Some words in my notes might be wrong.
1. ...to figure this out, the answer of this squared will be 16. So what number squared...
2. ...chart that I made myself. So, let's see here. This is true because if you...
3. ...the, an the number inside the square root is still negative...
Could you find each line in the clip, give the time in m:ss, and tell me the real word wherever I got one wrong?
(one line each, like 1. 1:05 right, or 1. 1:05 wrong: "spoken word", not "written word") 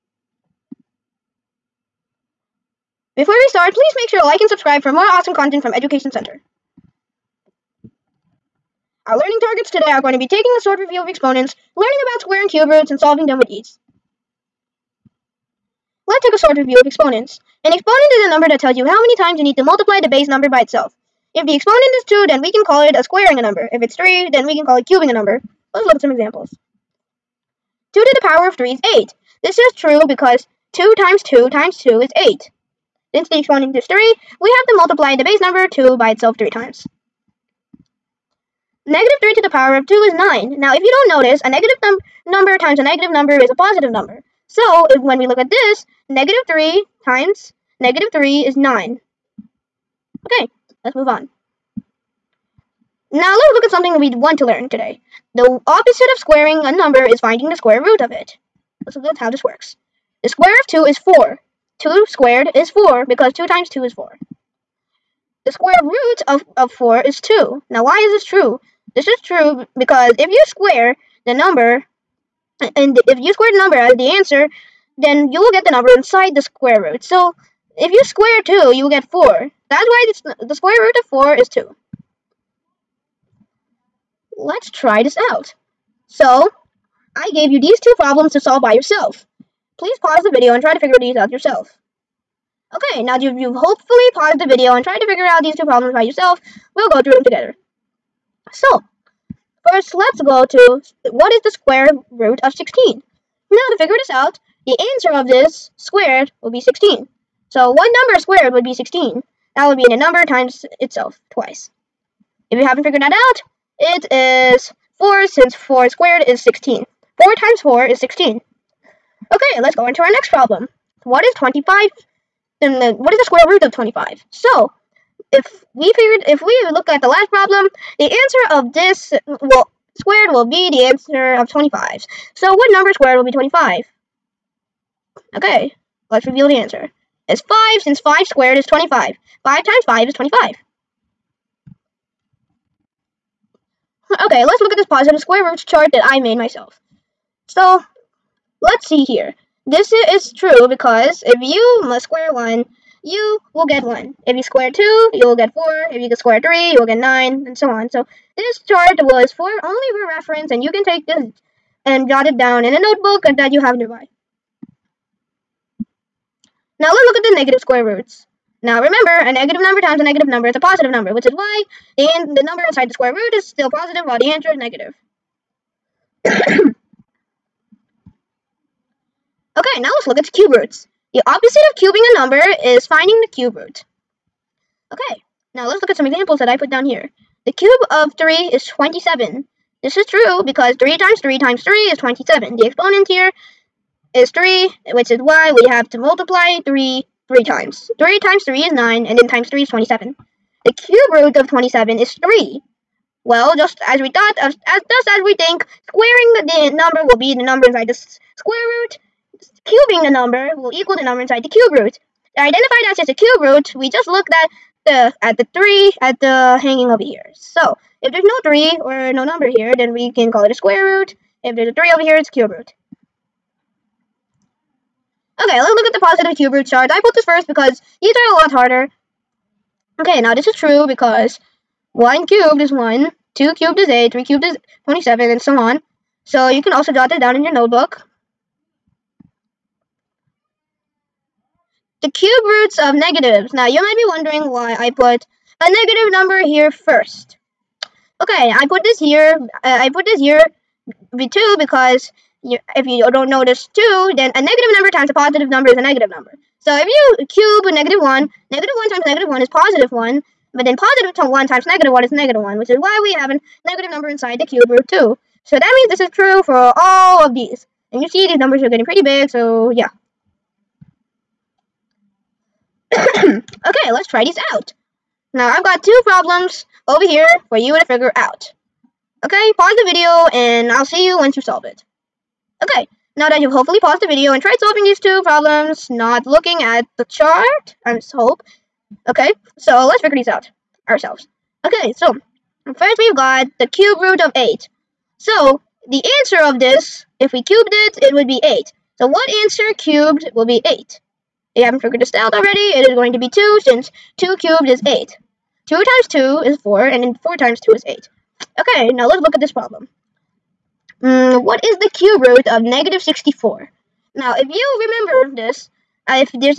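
1. 1:43 right
2. 2:25 right
3. 2:51 wrong: "positive", not "negative".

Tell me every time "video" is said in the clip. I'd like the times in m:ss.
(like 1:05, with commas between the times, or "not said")
1:30, 1:34, 4:39, 4:44.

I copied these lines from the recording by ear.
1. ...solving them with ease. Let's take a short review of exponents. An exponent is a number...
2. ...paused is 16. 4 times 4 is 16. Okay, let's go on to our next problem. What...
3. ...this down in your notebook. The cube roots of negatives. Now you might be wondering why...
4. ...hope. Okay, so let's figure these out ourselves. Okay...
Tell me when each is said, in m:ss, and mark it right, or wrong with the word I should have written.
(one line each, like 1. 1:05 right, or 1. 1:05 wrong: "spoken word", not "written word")
1. 0:12 right
2. 1:55 wrong: "squared", not "paused"
3. 3:57 right
4. 4:48 right.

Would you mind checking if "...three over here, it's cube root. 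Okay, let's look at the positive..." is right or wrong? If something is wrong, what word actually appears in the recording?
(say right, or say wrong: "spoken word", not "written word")
right.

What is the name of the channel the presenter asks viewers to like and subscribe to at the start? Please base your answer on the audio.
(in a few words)
Education Center.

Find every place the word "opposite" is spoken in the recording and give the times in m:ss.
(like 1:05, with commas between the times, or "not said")
0:55, 3:01.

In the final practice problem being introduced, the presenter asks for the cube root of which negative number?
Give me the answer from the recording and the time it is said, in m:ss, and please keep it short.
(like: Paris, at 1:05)
-64, at 5:12.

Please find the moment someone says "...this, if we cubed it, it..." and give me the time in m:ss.
4:56.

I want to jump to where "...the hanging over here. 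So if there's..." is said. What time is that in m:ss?
3:36.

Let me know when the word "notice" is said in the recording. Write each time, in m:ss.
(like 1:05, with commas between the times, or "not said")
0:41, 4:13.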